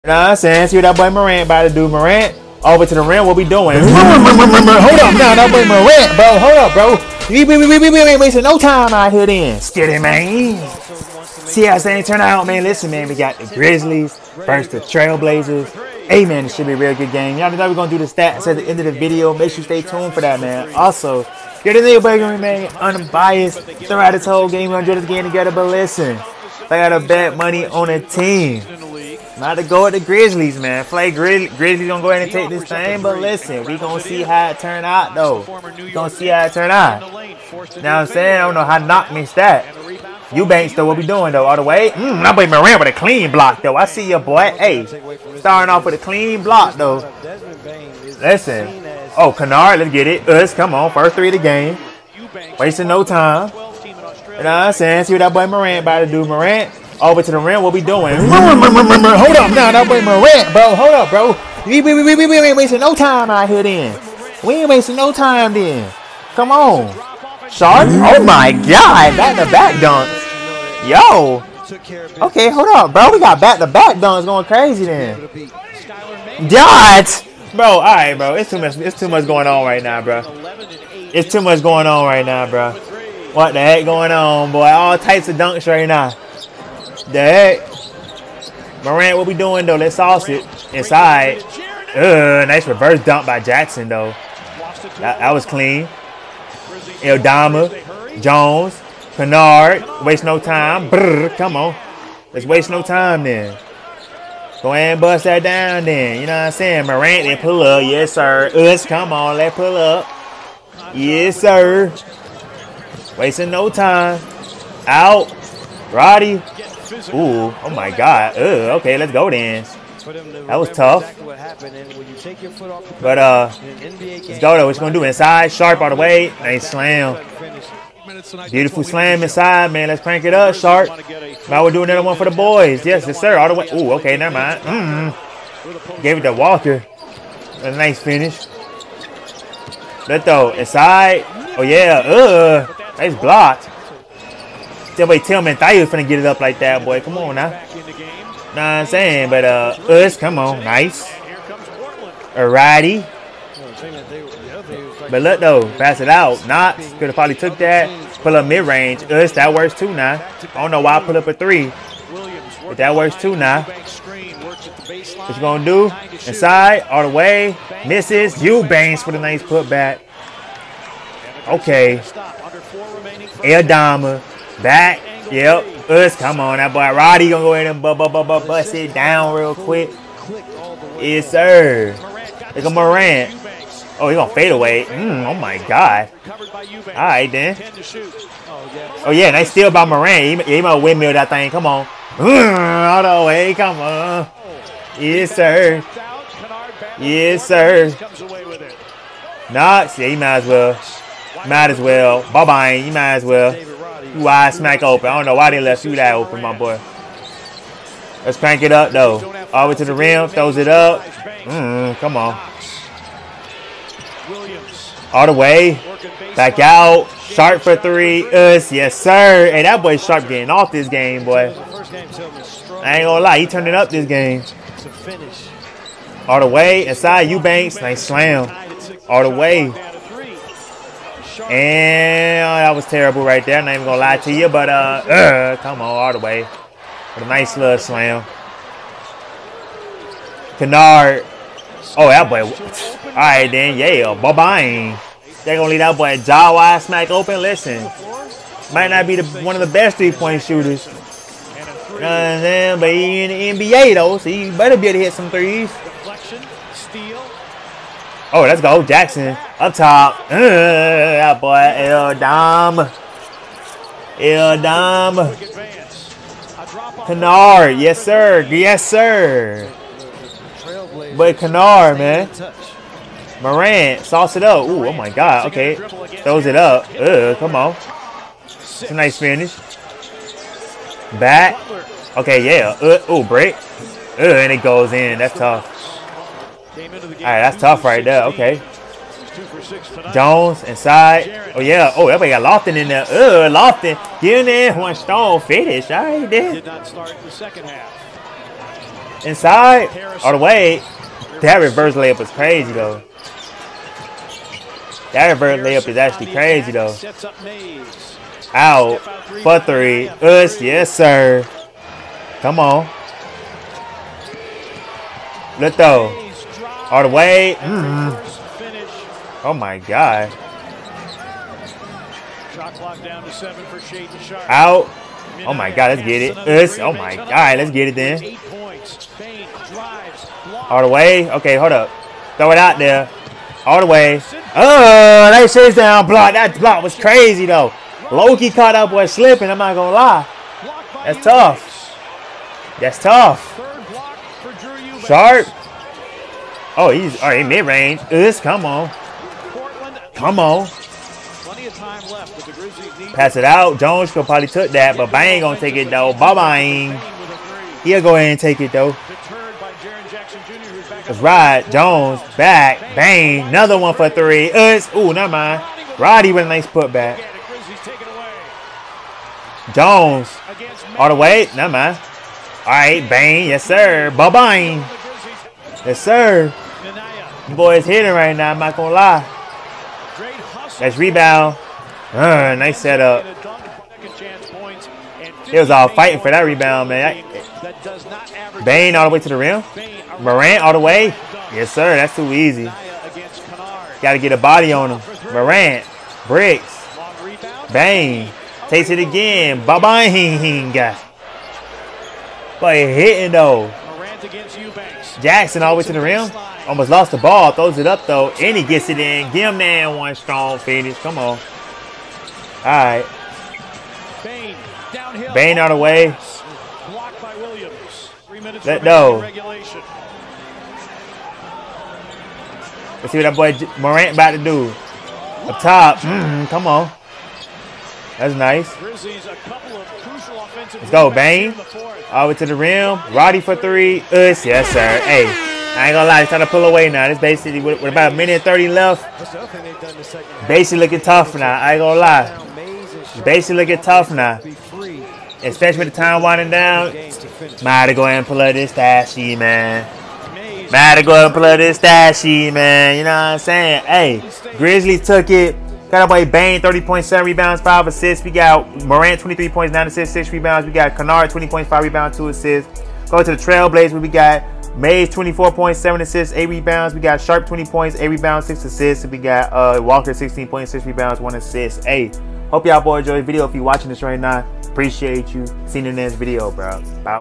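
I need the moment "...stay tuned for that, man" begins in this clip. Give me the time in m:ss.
0:19.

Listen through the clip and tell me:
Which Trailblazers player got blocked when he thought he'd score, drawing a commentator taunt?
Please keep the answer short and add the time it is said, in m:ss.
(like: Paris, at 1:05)
Tillman, at 2:25.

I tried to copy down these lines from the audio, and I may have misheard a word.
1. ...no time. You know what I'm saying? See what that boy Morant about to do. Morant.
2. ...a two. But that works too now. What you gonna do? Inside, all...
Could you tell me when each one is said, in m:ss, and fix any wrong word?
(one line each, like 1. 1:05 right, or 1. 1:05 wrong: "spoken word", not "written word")
1. 0:52 right
2. 2:41 wrong: "three", not "two".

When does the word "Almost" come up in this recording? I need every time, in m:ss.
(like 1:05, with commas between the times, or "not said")
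6:46.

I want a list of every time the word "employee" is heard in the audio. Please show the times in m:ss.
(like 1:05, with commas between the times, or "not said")
not said.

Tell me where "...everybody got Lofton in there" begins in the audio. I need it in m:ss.
4:52.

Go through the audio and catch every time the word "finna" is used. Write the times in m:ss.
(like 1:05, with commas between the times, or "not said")
2:25.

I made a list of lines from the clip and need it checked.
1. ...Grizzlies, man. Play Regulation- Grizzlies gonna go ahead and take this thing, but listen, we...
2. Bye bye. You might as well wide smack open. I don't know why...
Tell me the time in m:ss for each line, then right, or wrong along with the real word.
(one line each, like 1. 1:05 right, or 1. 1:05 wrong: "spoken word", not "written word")
1. 0:29 wrong: "Grizz", not "Regulation"
2. 3:22 right.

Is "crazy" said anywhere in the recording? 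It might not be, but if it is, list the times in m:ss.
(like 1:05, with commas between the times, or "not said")
1:14, 5:02, 5:06, 5:36.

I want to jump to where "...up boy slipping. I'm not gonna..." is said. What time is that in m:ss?
5:38.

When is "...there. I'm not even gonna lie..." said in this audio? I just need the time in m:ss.
3:53.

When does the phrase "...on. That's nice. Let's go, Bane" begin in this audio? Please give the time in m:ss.
7:06.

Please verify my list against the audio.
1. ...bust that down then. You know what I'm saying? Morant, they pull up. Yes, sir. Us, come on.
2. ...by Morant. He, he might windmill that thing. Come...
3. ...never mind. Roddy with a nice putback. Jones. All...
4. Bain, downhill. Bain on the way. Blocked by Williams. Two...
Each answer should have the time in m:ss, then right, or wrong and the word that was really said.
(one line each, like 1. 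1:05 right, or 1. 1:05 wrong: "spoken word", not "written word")
1. 1:45 right
2. 3:09 right
3. 6:05 right
4. 6:54 wrong: "Three", not "Two".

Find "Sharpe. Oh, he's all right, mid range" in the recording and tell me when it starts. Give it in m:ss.
5:45.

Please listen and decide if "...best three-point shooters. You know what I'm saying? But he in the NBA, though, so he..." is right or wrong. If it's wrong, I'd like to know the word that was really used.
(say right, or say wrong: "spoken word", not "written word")
right.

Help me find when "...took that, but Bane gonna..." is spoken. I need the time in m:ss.
5:54.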